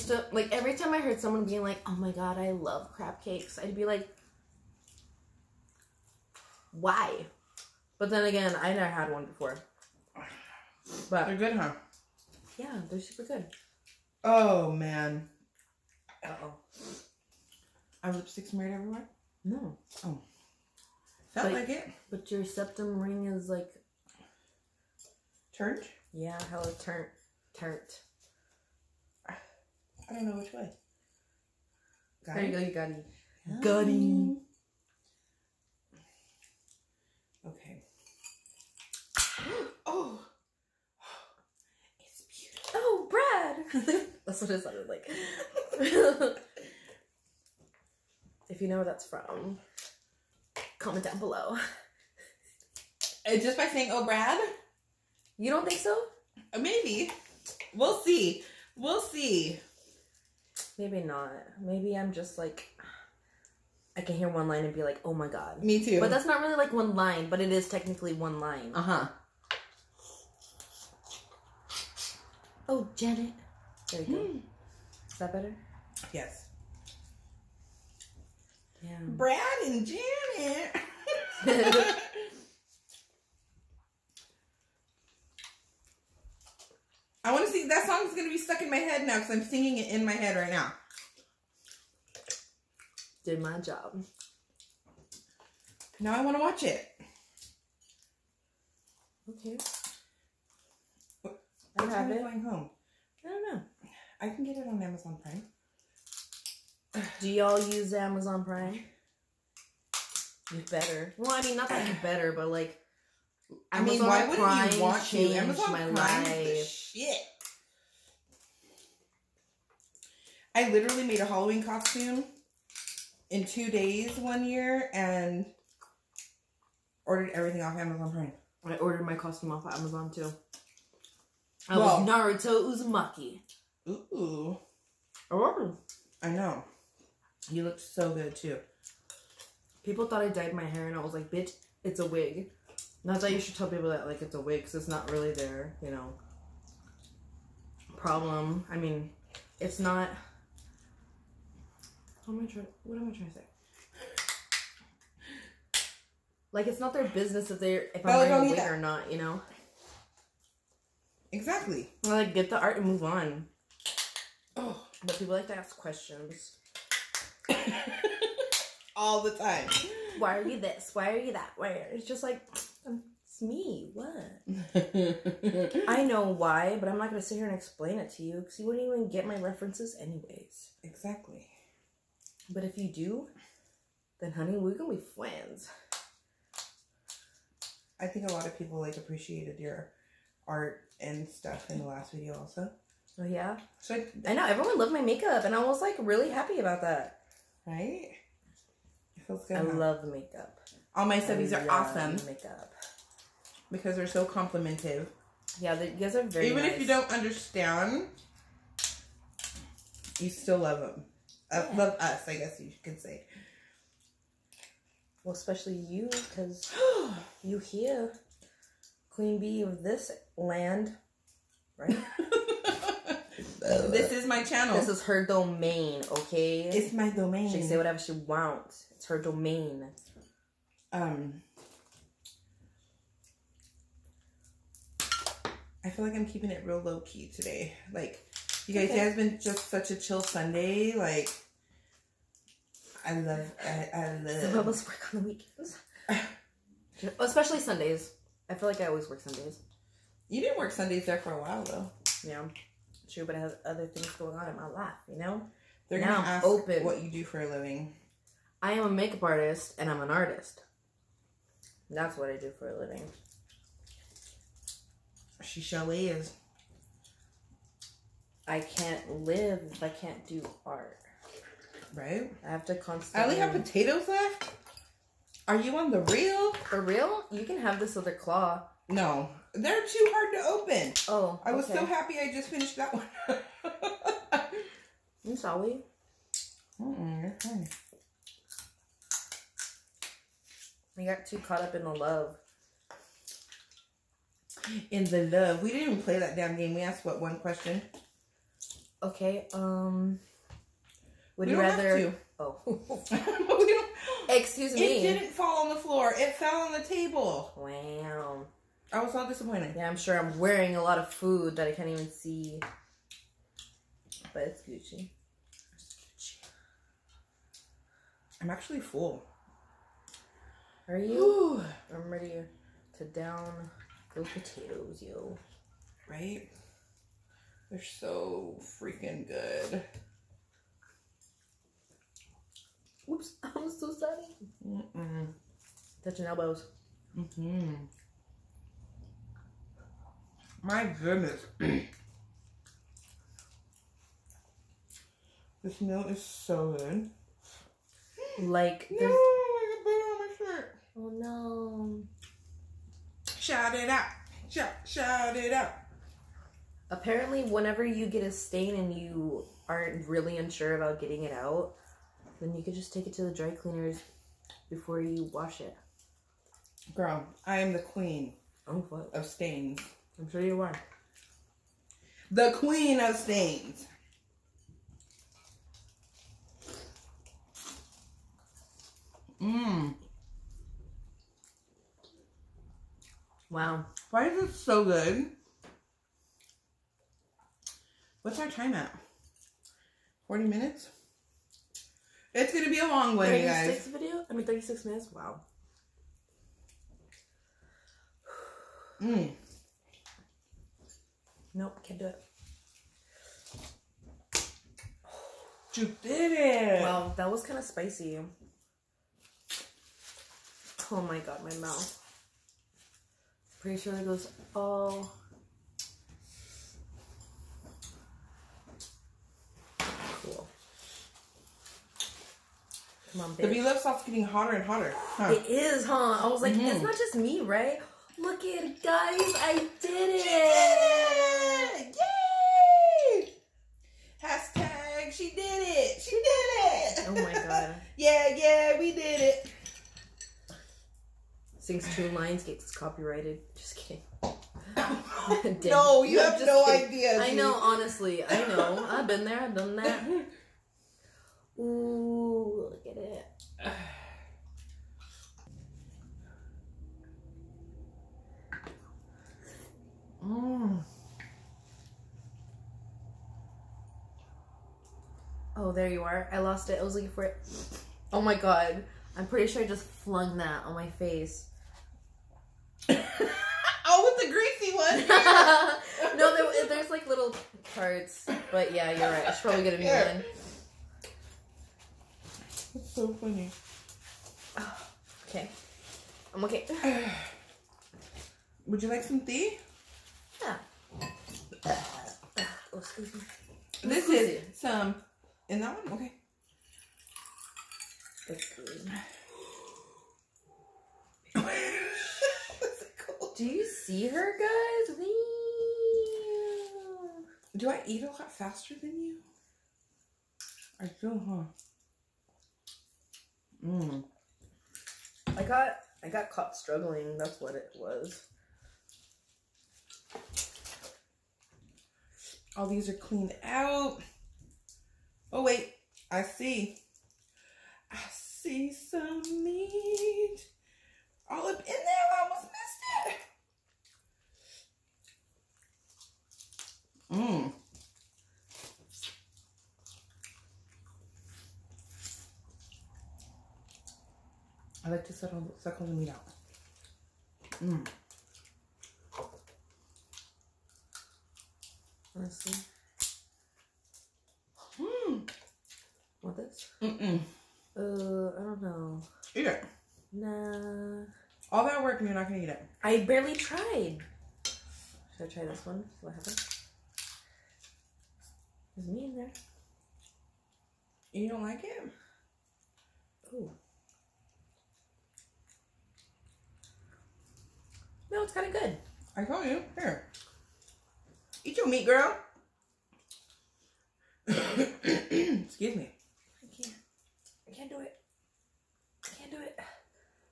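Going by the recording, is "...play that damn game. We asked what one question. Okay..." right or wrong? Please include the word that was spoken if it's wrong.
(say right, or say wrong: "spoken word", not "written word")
right.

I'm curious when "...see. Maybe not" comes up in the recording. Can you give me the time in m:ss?
0:58.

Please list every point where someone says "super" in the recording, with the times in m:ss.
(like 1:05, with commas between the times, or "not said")
0:12.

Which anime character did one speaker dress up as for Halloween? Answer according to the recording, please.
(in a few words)
Naruto Uzumaki.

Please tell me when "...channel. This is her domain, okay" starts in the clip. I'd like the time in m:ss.
3:44.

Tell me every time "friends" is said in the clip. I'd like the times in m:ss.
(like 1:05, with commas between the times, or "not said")
3:05.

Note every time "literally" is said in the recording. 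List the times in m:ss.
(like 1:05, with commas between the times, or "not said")
2:00.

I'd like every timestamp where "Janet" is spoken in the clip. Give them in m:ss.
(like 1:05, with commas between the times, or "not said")
1:12, 1:19.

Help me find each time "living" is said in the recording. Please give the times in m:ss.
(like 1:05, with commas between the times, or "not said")
4:17, 4:22.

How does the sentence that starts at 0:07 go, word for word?
But then again, I never had one before.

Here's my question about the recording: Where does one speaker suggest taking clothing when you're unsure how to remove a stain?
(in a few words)
Dry cleaners.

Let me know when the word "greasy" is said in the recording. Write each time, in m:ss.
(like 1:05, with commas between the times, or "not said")
7:54.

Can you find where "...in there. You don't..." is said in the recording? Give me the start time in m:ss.
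9:29.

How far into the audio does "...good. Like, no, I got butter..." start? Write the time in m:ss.
5:46.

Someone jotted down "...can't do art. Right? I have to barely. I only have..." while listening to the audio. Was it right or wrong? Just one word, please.
wrong.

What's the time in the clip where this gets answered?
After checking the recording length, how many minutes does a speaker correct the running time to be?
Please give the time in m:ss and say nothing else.
6:34.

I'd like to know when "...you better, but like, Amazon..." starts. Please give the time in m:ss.
1:51.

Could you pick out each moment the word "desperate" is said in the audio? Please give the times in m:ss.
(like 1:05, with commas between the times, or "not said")
not said.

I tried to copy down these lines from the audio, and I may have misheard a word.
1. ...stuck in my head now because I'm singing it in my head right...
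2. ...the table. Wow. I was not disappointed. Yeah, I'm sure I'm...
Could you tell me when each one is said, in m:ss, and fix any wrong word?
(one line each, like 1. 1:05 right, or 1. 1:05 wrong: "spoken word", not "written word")
1. 1:28 right
2. 5:06 right.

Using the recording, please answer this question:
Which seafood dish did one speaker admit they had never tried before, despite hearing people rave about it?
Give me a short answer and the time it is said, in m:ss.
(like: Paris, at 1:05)
Crab cakes, at 0:02.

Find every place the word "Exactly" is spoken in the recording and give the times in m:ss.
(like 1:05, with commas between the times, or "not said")
2:41, 3:00.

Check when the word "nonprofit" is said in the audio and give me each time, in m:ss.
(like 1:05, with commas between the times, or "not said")
not said.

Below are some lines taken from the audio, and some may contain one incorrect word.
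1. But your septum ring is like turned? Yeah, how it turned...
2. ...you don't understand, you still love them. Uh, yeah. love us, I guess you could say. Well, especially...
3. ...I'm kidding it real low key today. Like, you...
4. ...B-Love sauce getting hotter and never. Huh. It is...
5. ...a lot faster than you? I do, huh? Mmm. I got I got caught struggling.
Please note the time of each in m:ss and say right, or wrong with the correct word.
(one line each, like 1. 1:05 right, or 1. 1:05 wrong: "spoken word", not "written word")
1. 0:22 right
2. 3:26 right
3. 3:56 wrong: "keeping", not "kidding"
4. 7:03 wrong: "hotter", not "never"
5. 8:28 right.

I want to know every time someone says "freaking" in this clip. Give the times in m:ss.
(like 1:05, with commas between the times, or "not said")
5:28.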